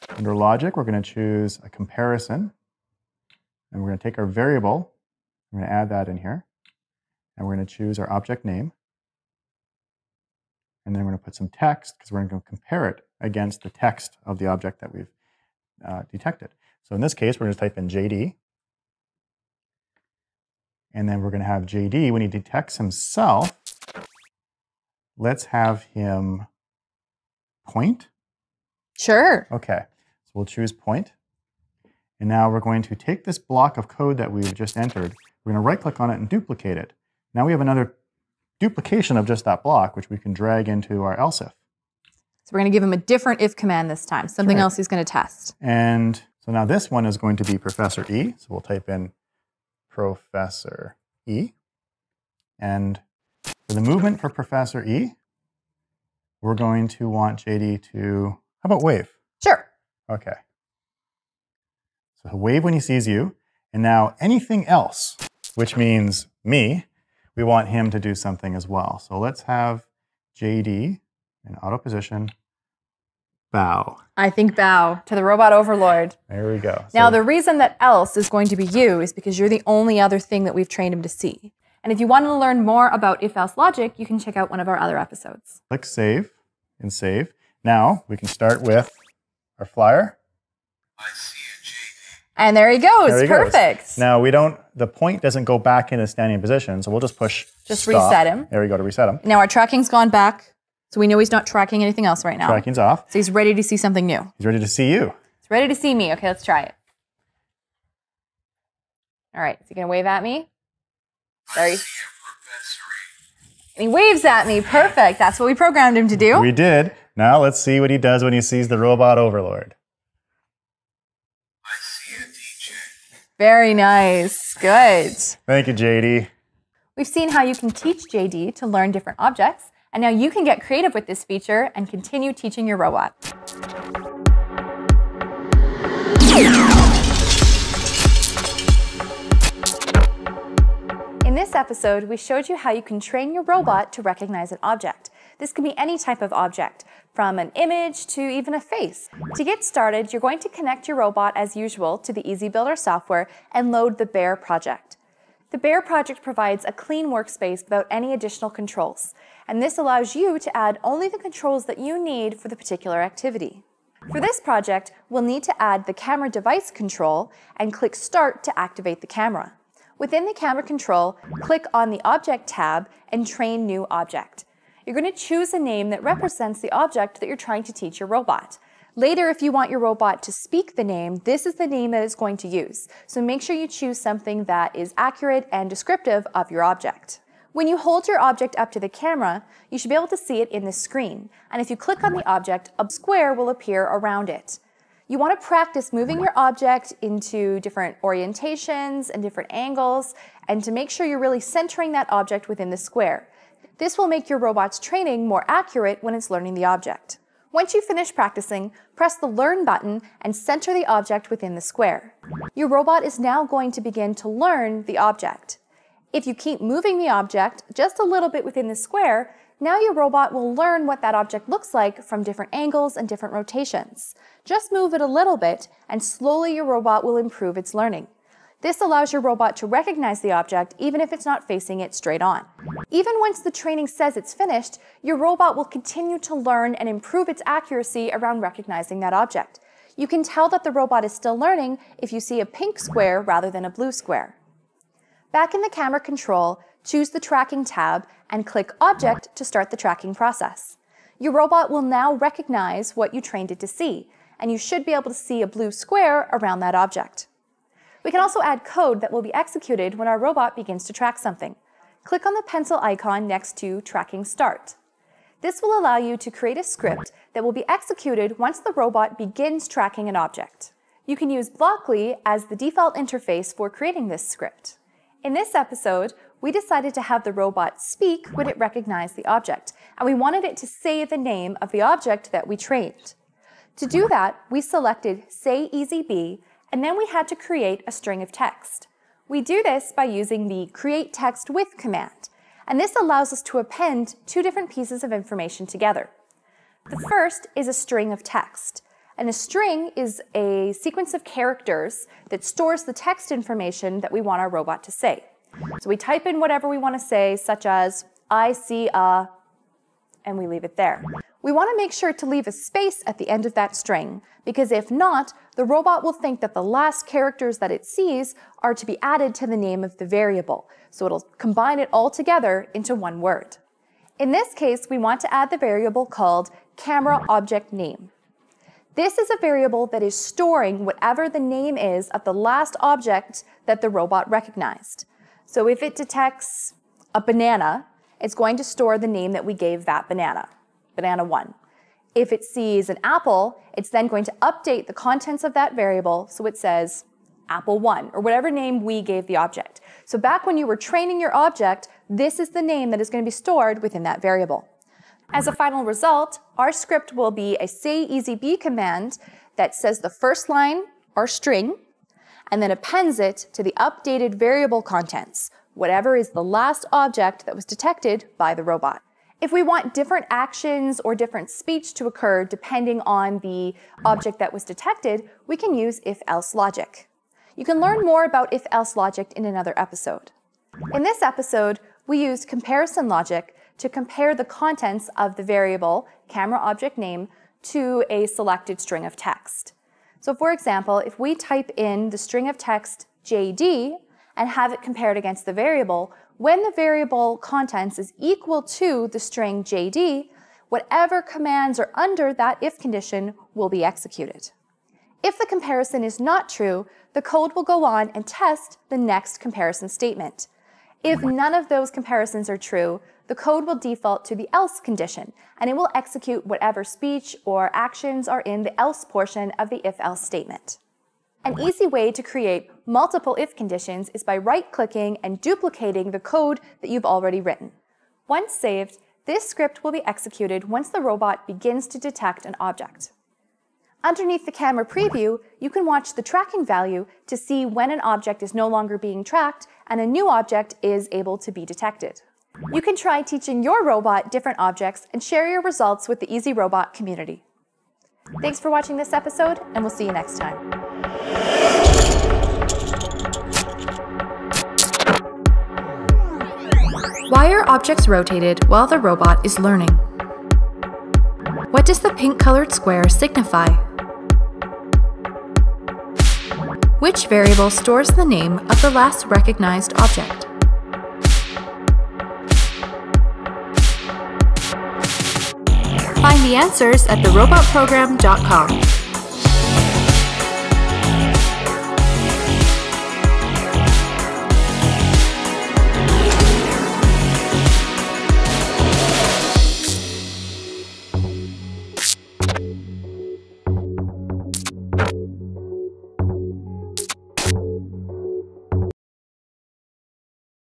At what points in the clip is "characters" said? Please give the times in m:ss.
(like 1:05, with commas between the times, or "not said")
5:01, 5:17.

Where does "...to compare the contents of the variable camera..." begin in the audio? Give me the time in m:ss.
6:23.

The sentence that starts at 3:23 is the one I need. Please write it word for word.
This will make your robot's training more accurate when it's learning the object.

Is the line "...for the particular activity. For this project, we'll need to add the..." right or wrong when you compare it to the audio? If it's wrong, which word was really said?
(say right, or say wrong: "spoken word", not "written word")
right.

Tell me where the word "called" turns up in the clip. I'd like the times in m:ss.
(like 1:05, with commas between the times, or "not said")
5:26.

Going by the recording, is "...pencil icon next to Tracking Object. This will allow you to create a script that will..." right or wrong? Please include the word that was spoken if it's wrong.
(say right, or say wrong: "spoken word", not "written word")
wrong: "Start", not "Object".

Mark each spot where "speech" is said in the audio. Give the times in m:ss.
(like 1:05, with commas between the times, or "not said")
6:11, 6:56.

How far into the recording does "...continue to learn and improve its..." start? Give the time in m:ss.
3:55.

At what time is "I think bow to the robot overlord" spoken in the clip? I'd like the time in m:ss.
1:14.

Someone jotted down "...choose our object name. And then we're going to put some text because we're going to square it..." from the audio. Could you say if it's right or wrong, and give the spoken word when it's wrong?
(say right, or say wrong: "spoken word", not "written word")
wrong: "compare", not "square".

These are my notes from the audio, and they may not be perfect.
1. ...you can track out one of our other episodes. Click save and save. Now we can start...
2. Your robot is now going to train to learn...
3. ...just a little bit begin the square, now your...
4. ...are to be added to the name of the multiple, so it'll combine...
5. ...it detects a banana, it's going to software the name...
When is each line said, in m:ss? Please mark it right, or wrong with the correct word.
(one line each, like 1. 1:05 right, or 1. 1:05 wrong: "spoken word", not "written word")
1. 1:23 wrong: "check", not "track"
2. 3:32 wrong: "begin", not "train"
3. 3:37 wrong: "within", not "begin"
4. 5:18 wrong: "variable", not "multiple"
5. 5:35 wrong: "store", not "software".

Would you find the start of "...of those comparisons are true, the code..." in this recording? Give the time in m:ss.
6:51.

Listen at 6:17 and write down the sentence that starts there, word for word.
You can learn more about if-else logic in another episode.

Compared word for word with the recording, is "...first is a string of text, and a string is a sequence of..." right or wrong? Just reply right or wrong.
right.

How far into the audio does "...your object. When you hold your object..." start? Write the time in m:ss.
3:06.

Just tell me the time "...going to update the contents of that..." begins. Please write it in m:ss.
5:44.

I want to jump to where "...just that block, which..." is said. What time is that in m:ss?
0:39.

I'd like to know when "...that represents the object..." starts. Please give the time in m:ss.
2:55.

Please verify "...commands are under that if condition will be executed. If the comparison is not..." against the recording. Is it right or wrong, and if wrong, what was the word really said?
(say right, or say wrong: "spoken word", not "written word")
right.